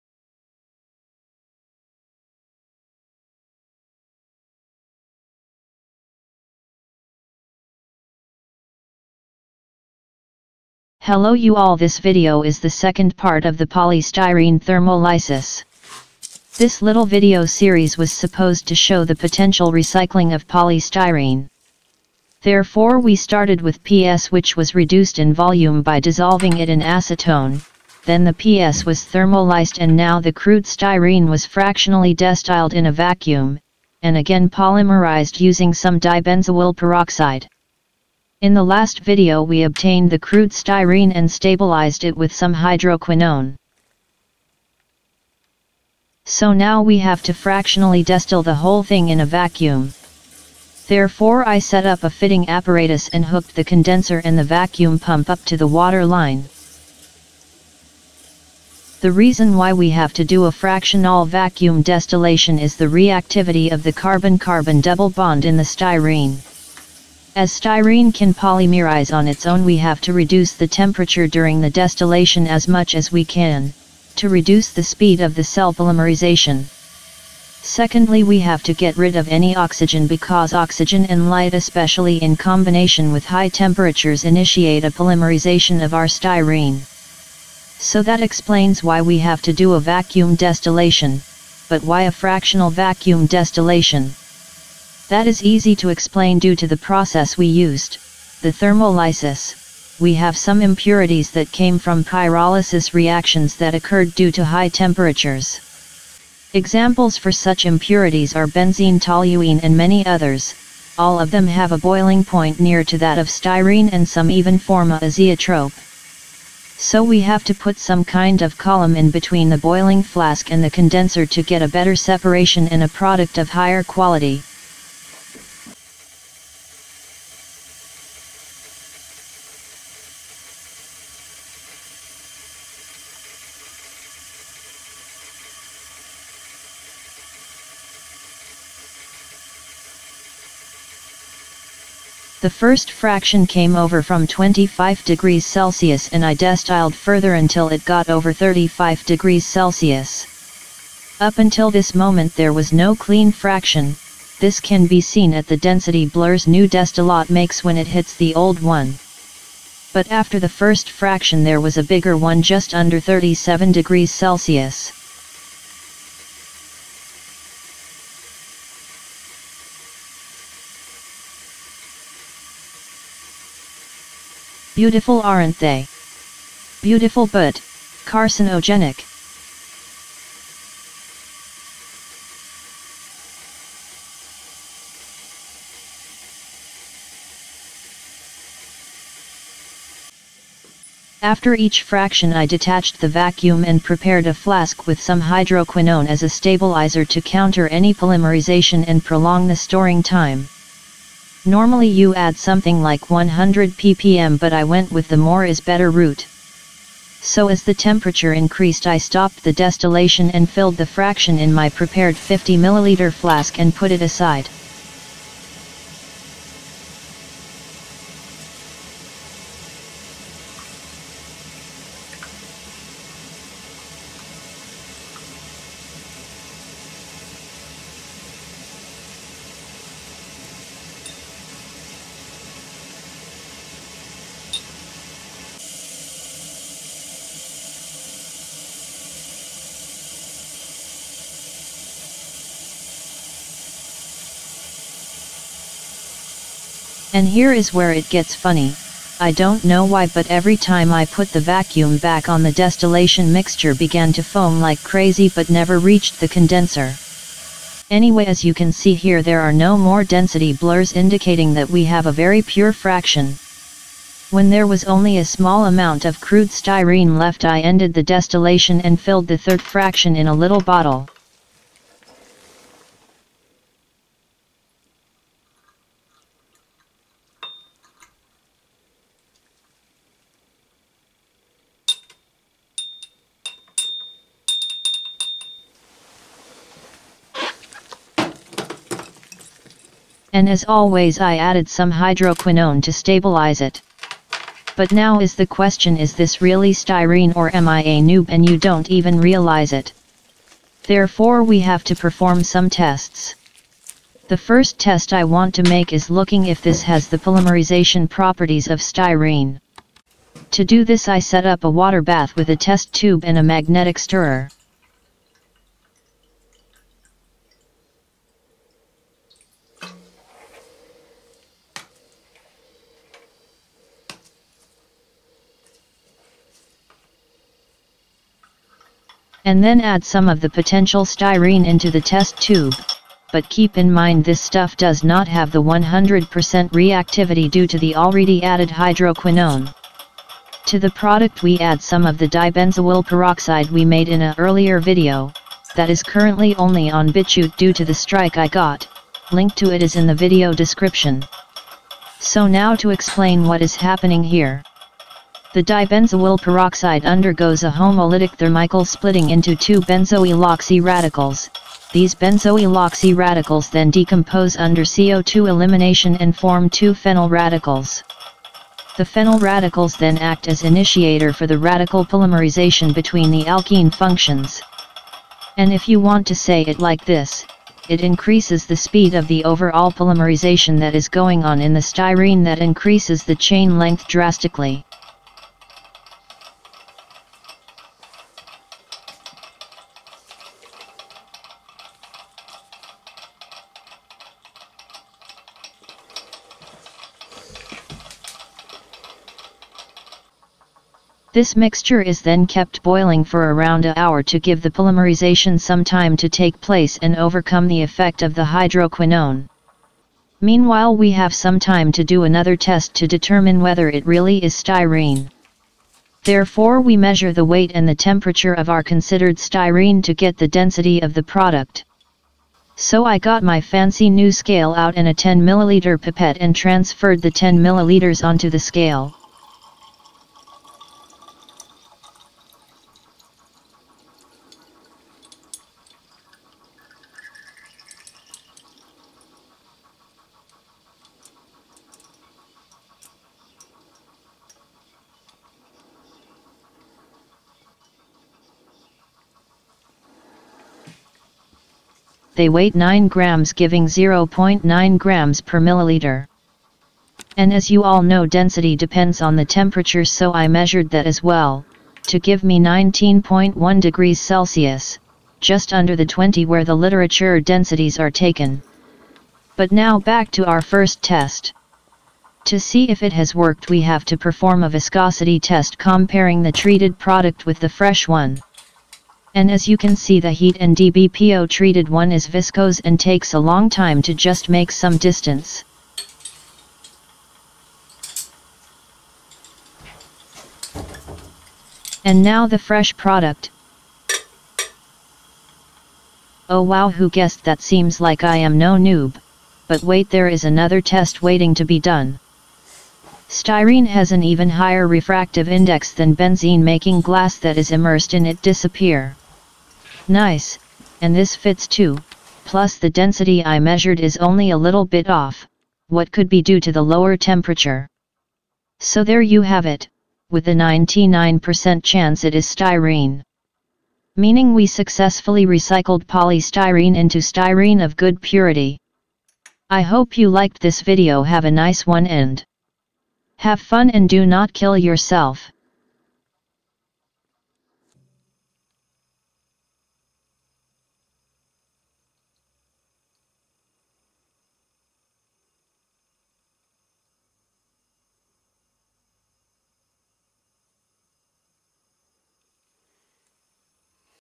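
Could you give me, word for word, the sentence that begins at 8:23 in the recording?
Styrene has an even higher refractive index than benzene making glass that is immersed in it disappear.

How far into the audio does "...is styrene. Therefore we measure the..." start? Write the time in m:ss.
6:54.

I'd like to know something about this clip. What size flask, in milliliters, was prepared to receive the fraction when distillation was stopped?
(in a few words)
50 milliliters.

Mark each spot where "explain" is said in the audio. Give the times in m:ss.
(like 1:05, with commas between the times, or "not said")
1:28, 1:35, 5:52.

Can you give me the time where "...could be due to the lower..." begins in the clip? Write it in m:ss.
8:36.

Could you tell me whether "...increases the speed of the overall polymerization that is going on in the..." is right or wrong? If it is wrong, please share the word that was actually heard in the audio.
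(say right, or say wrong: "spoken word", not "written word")
right.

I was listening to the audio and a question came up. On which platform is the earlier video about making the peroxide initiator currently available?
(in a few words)
BitChute.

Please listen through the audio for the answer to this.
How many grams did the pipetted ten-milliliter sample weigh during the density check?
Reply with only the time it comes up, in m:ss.
7:32.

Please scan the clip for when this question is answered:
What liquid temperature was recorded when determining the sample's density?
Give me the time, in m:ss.
7:42.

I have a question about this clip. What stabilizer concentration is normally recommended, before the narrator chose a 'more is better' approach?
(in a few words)
100 ppm.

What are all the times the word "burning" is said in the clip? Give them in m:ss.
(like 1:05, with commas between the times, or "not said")
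not said.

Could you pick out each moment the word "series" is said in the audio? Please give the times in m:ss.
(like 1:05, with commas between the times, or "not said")
0:17.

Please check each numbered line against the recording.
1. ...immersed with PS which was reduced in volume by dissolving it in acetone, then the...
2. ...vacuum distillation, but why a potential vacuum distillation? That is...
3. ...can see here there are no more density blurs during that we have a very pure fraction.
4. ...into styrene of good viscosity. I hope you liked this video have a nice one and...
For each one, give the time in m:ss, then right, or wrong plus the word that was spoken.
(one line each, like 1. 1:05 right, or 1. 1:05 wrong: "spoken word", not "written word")
1. 0:23 wrong: "started", not "immersed"
2. 1:29 wrong: "fractional", not "potential"
3. 4:18 wrong: "indicating", not "during"
4. 8:46 wrong: "purity", not "viscosity".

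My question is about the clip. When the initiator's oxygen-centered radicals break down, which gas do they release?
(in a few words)
CO2.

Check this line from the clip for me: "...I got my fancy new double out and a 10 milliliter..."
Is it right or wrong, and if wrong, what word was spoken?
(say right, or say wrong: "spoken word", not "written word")
wrong: "scale", not "double".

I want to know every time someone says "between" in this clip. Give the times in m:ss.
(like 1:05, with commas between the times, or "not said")
1:59, 6:12.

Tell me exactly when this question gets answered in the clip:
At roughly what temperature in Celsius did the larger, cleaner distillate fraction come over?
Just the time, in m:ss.
2:42.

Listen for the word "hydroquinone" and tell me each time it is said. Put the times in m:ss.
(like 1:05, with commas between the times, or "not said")
0:42, 3:15, 4:51, 5:38, 6:48.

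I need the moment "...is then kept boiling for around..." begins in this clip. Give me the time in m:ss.
6:42.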